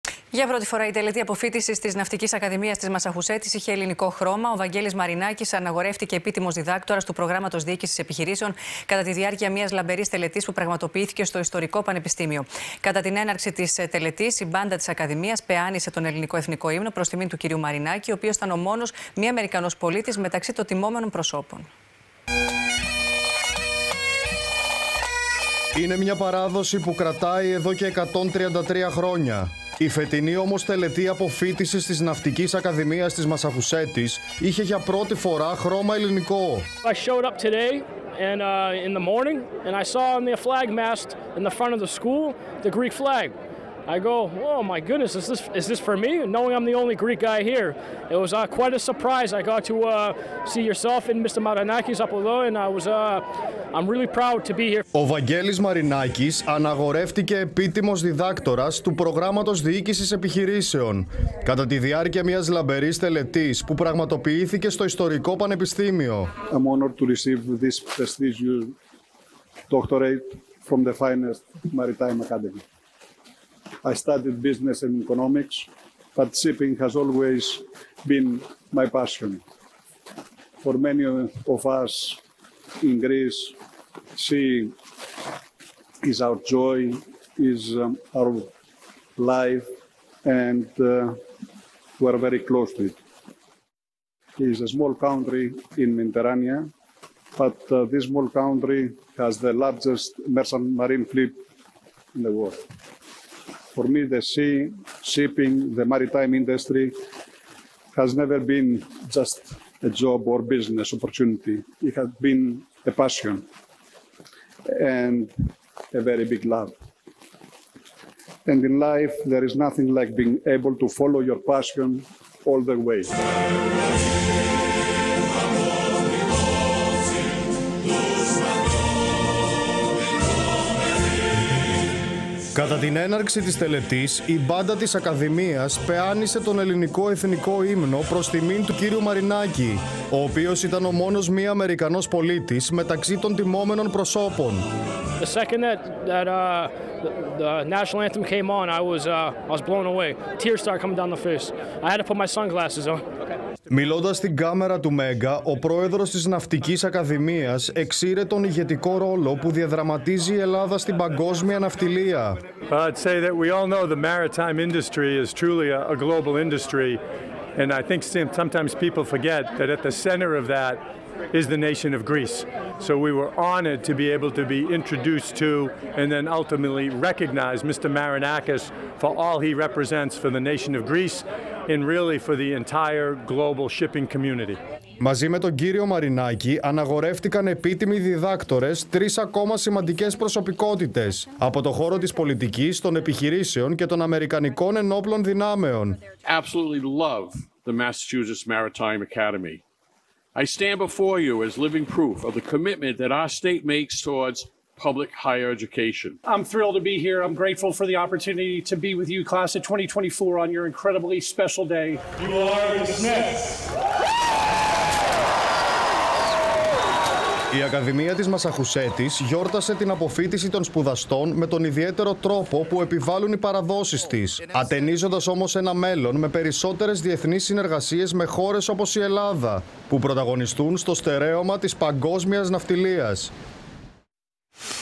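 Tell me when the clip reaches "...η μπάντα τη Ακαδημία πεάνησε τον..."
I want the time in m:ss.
0:14.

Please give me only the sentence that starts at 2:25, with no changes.
The second that, that uh, the, national anthem came on, I was, uh, I was blown away.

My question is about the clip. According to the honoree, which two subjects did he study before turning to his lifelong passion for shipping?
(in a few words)
business and economics.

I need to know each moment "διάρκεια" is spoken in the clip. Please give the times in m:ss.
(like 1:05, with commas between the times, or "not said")
0:09, 1:01.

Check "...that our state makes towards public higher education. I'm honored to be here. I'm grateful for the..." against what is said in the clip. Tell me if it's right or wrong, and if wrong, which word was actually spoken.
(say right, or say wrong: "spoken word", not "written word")
wrong: "thrilled", not "honored".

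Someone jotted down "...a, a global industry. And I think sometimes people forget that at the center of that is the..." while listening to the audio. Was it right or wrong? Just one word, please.
right.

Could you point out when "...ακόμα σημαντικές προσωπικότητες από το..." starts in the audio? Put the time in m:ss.
3:09.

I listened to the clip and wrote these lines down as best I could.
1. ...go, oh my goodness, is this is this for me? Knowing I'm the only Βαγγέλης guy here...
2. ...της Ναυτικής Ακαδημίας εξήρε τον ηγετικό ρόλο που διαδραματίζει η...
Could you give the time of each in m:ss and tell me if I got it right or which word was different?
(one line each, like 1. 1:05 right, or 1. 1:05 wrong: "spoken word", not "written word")
1. 0:43 wrong: "Greek", not "Βαγγέλης"
2. 2:36 right.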